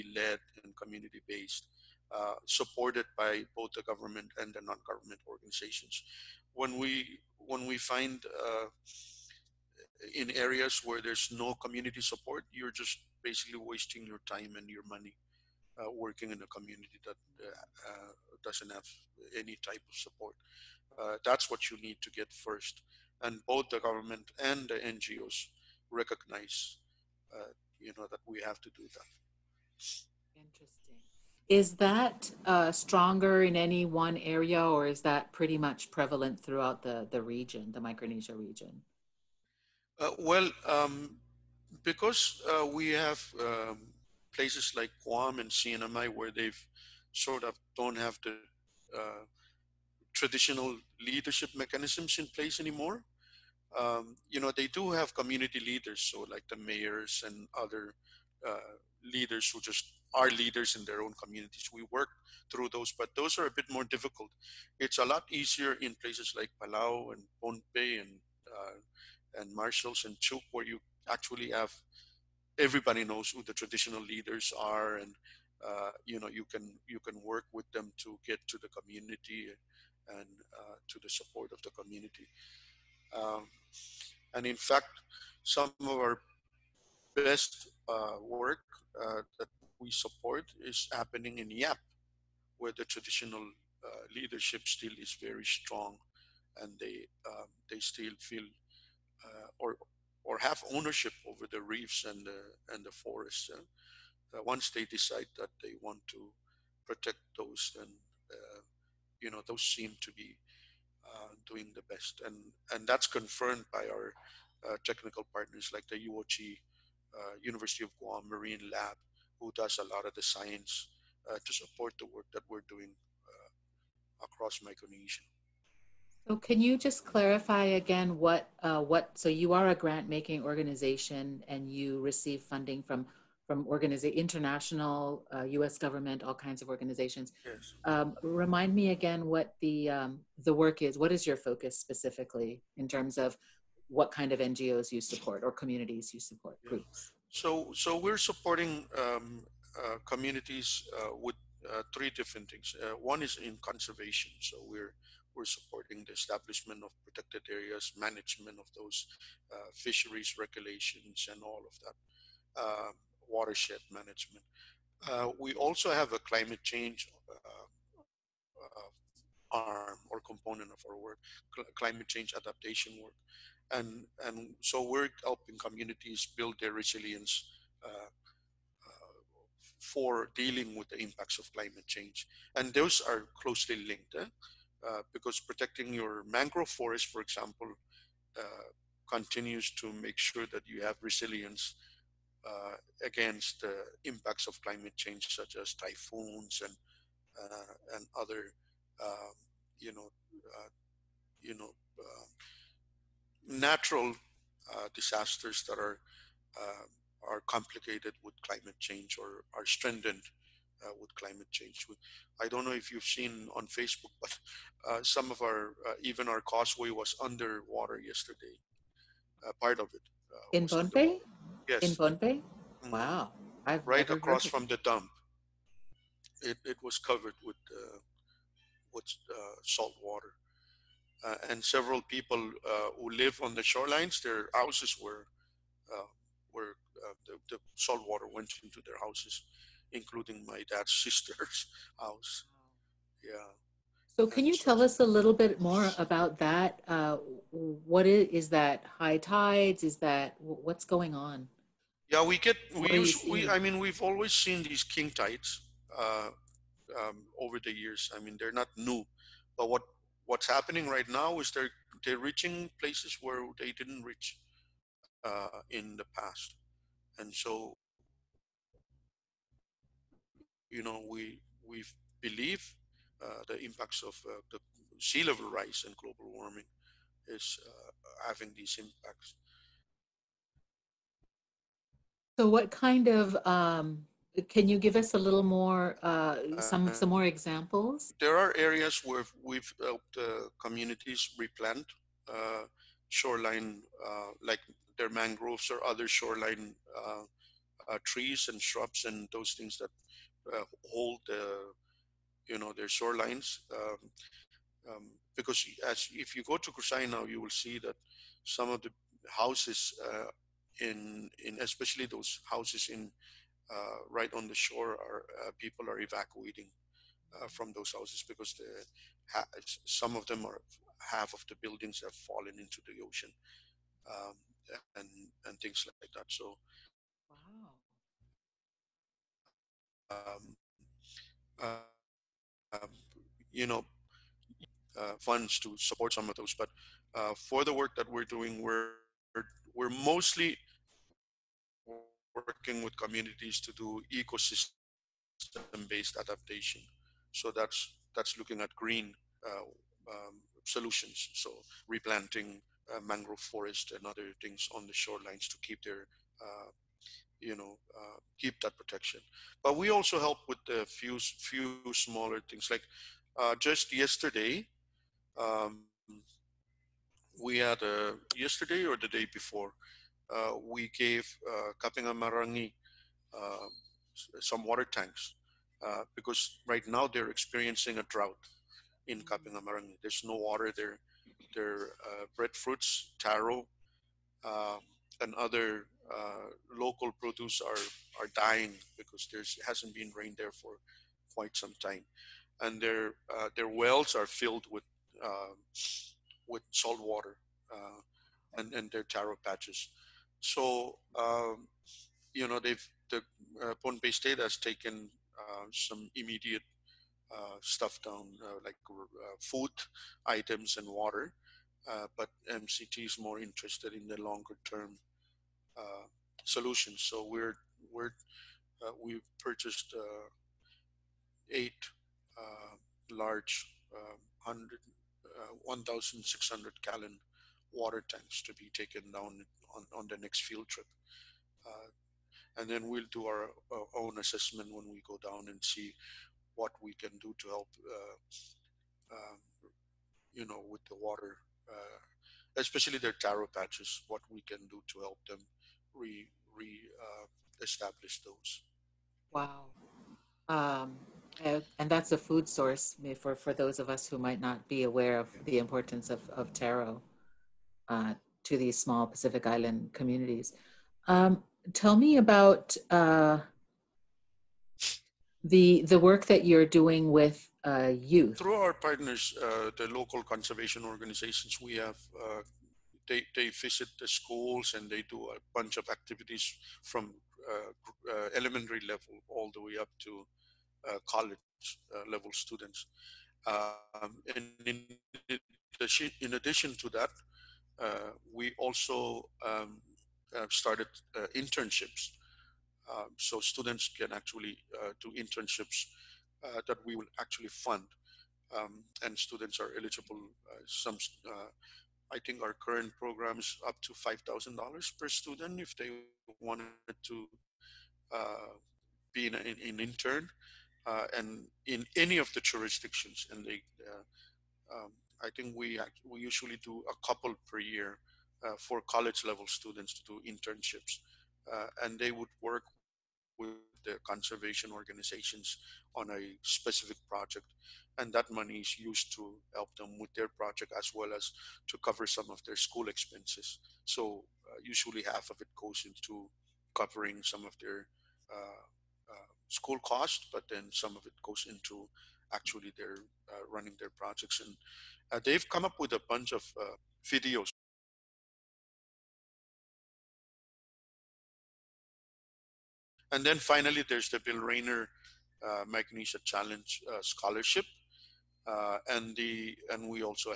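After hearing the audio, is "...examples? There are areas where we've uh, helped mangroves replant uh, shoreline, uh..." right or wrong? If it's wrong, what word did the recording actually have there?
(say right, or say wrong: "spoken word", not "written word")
wrong: "communities", not "mangroves".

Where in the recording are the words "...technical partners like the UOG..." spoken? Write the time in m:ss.
1:54.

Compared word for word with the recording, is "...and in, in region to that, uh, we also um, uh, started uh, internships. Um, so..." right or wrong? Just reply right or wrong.
wrong.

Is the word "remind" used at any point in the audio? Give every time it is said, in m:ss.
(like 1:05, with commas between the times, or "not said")
2:18.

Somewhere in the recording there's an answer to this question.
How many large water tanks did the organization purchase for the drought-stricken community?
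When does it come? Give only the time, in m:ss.
7:01.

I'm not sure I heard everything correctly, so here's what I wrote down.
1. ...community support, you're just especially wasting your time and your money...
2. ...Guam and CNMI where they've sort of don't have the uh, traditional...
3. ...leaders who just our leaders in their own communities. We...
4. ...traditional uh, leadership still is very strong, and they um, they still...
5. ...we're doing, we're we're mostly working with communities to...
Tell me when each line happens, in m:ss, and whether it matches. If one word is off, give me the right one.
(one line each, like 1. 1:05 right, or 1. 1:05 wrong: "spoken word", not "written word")
1. 0:11 wrong: "basically", not "especially"
2. 0:45 right
3. 0:59 right
4. 1:32 right
5. 5:38 right.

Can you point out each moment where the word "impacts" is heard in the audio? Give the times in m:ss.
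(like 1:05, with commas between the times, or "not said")
3:00, 3:14, 4:33, 4:38.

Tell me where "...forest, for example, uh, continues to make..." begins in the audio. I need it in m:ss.
3:06.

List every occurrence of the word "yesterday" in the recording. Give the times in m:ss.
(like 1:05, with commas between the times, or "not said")
3:37, 6:03, 6:08.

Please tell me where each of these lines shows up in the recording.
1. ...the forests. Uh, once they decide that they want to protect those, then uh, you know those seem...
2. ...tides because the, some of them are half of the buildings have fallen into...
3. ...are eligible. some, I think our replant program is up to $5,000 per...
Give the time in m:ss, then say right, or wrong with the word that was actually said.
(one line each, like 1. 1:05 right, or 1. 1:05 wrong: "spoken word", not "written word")
1. 1:42 right
2. 5:17 wrong: "houses", not "tides"
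3. 8:19 wrong: "current", not "replant".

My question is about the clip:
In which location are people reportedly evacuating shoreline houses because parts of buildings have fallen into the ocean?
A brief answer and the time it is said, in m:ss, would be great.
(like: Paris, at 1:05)
Kosrae, at 5:06.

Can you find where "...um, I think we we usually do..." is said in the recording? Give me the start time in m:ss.
8:34.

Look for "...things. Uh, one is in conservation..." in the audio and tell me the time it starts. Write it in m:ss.
2:32.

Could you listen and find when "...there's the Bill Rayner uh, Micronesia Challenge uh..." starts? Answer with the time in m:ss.
9:13.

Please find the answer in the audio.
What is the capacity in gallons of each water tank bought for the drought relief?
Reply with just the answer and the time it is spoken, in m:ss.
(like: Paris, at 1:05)
1,600, at 7:05.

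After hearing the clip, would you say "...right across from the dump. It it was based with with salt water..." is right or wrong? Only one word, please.
wrong.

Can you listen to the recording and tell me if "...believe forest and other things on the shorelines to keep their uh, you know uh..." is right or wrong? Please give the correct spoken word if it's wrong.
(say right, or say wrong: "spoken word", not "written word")
wrong: "mangrove", not "believe".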